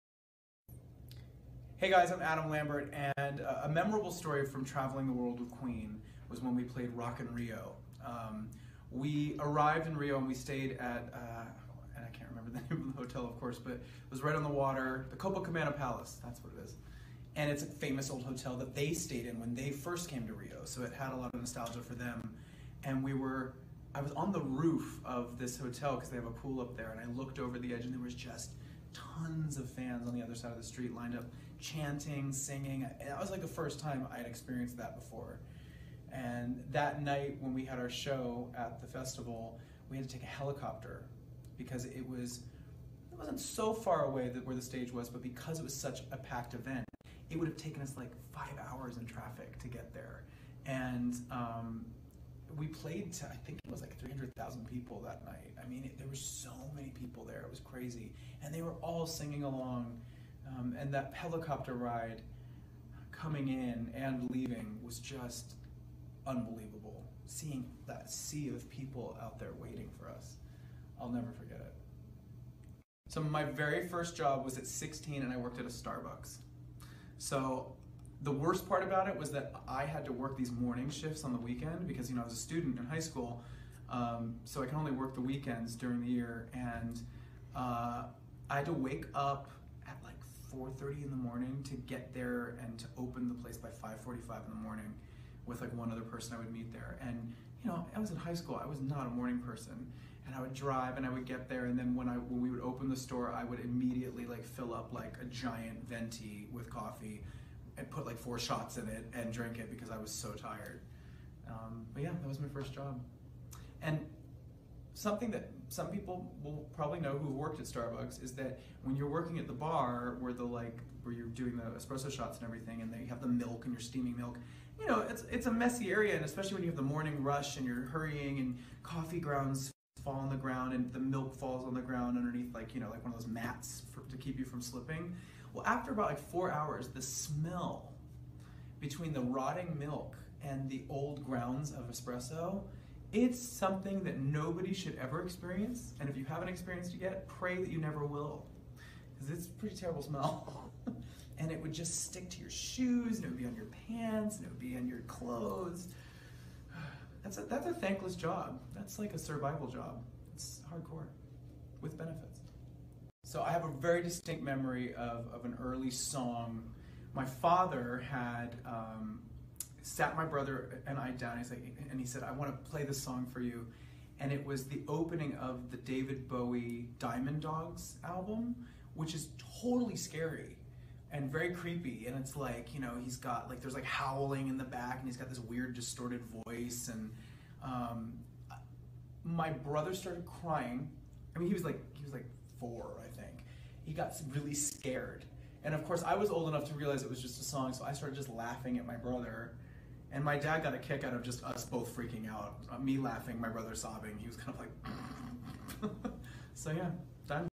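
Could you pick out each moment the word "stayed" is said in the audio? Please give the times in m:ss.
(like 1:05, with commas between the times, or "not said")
0:10, 0:18.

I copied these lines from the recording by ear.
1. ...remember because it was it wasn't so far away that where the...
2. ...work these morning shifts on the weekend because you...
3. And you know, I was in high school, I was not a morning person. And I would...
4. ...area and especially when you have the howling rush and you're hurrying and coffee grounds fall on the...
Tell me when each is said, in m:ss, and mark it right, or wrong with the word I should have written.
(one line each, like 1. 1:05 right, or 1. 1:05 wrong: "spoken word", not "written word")
1. 0:40 wrong: "helicopter", not "remember"
2. 1:20 right
3. 1:37 right
4. 2:05 wrong: "morning", not "howling".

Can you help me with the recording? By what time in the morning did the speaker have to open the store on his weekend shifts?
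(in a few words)
5:45.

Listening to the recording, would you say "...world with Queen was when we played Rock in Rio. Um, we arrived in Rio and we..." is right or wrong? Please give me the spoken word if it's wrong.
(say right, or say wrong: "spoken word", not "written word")
right.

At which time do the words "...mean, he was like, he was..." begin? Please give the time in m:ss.
3:11.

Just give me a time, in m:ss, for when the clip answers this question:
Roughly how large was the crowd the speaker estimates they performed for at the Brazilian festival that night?
0:53.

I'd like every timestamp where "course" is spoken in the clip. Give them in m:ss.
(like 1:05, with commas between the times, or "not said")
0:13, 3:15.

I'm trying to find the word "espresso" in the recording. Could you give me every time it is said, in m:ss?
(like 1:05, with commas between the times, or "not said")
2:01, 2:21.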